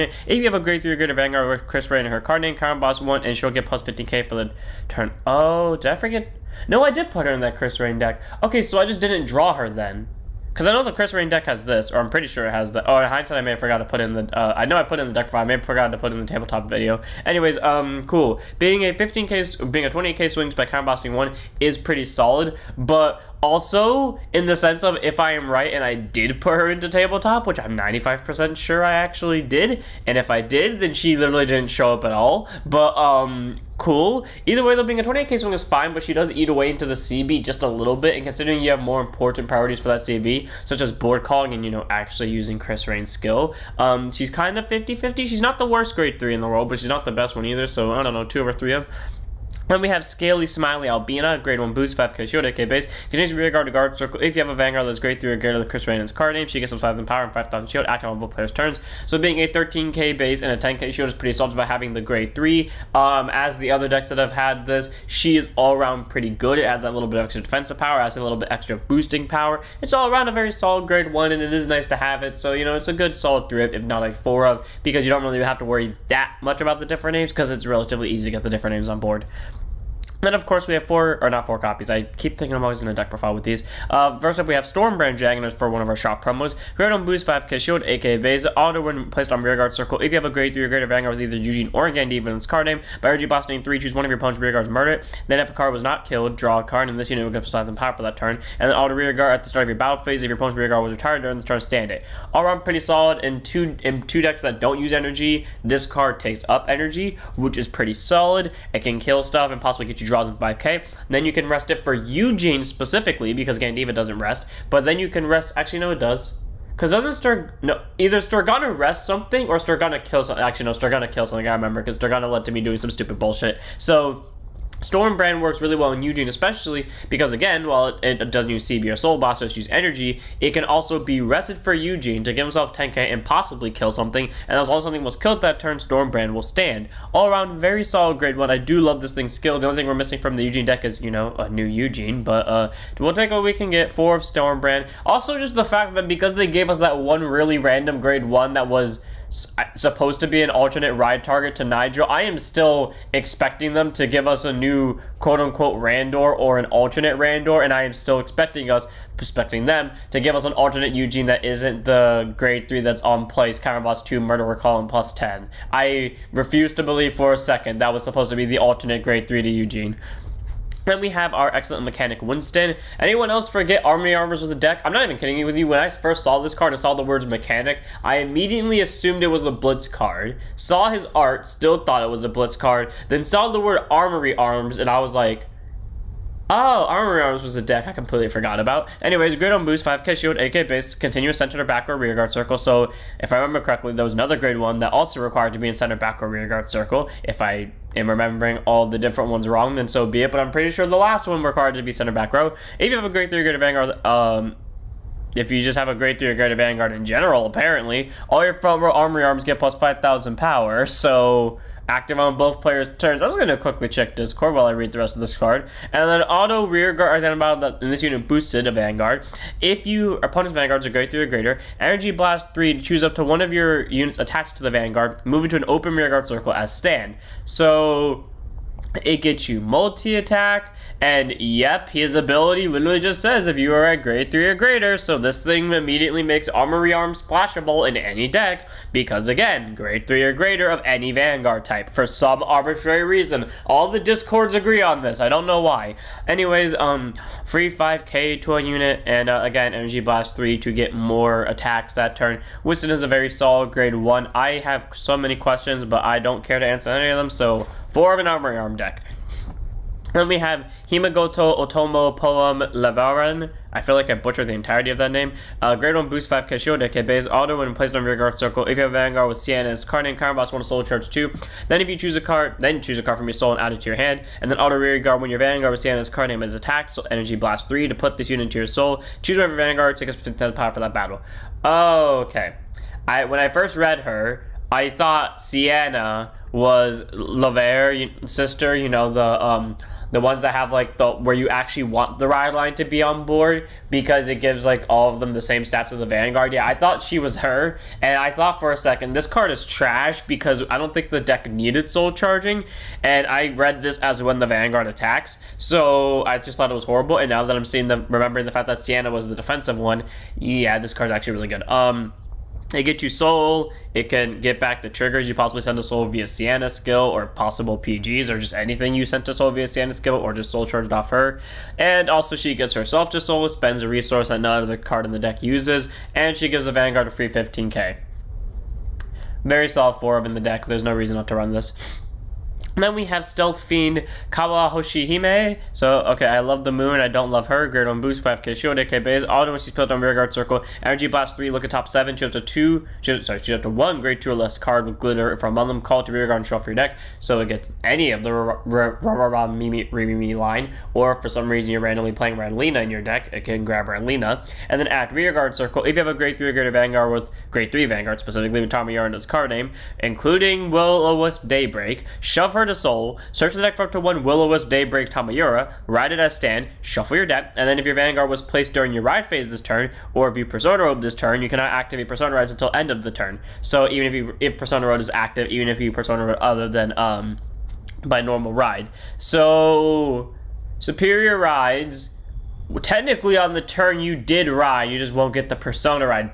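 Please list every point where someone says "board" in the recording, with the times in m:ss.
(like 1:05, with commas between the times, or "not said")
0:40, 1:18, 4:53.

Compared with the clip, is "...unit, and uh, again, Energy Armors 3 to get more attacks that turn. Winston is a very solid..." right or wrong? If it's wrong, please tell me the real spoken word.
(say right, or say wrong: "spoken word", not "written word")
wrong: "Blast", not "Armors".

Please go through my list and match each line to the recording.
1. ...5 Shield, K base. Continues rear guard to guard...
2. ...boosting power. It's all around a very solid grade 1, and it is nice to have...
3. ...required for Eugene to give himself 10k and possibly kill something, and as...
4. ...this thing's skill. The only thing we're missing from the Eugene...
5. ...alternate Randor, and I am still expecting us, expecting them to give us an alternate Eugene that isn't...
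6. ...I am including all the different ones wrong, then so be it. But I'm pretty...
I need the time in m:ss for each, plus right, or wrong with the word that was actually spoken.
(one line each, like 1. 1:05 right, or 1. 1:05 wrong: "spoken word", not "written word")
1. 0:51 right
2. 1:08 right
3. 2:11 wrong: "rested", not "required"
4. 2:19 right
5. 2:36 right
6. 3:17 wrong: "remembering", not "including".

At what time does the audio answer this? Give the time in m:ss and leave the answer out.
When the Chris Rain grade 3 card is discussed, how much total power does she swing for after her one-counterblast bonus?
0:19.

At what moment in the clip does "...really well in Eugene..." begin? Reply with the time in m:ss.
2:05.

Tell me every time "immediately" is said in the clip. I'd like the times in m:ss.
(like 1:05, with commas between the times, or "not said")
2:58, 3:55.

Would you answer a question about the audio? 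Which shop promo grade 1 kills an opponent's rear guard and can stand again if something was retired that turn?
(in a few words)
Stormbrand Dragon.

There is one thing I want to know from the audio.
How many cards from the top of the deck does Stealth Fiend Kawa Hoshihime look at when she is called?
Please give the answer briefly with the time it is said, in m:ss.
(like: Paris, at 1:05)
7, at 5:41.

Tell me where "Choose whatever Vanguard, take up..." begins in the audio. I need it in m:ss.
4:39.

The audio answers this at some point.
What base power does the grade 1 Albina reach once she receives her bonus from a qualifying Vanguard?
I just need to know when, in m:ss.
0:59.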